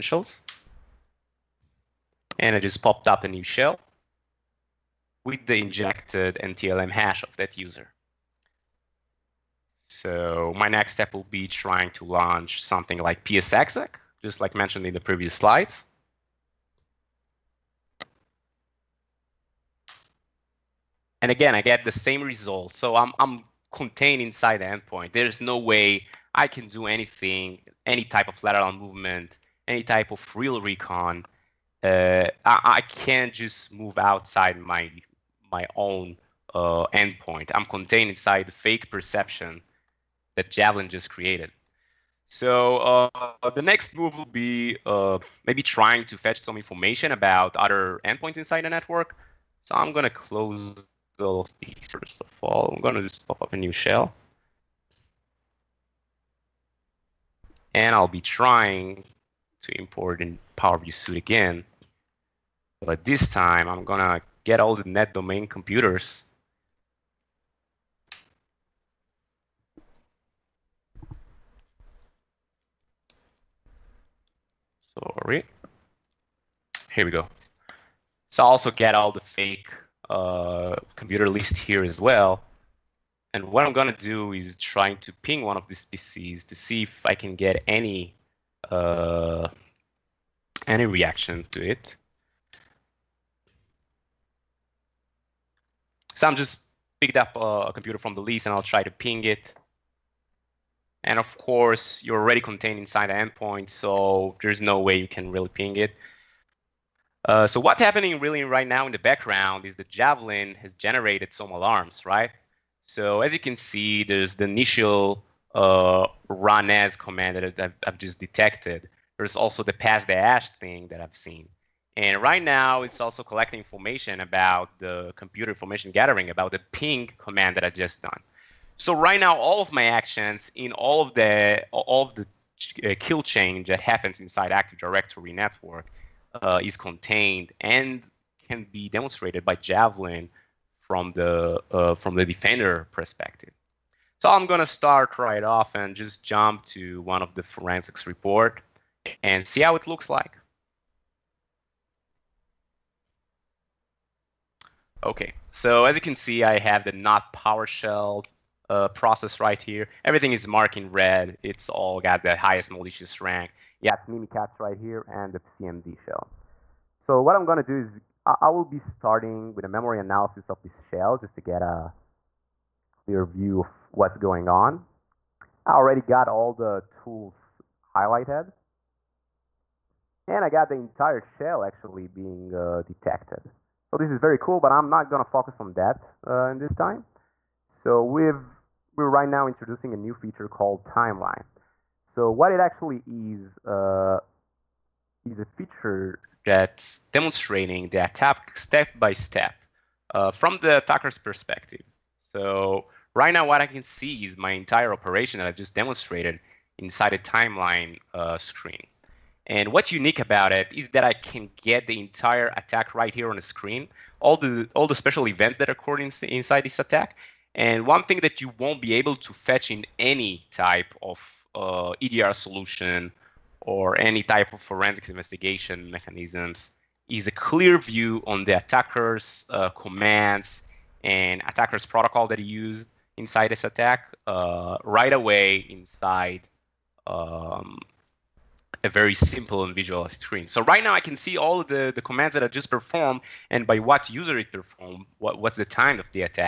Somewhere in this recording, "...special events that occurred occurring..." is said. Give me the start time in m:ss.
3:34.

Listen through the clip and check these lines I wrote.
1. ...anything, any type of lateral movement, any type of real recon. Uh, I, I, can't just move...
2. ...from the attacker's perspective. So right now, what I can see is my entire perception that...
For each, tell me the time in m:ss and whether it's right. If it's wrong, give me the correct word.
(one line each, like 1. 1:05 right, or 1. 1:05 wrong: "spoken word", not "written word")
1. 0:26 right
2. 3:20 wrong: "operation", not "perception".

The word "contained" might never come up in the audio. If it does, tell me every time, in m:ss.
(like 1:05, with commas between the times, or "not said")
0:23, 0:37, 1:42, 2:16.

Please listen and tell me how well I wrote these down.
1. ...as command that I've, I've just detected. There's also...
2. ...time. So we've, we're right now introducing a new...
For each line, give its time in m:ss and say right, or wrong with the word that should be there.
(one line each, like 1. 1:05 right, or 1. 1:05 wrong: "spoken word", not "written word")
1. 1:56 right
2. 3:06 right.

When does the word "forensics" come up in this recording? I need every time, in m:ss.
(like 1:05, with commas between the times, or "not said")
2:27, 3:44.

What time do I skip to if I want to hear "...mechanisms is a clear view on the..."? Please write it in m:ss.
3:45.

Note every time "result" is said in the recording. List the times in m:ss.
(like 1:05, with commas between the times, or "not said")
0:22.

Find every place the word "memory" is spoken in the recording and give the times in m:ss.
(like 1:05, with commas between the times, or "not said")
2:49.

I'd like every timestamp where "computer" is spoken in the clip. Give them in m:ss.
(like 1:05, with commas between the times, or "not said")
1:05, 1:20, 1:37, 2:05.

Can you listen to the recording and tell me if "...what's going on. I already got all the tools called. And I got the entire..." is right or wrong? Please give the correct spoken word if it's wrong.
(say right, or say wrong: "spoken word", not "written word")
wrong: "highlighted", not "called".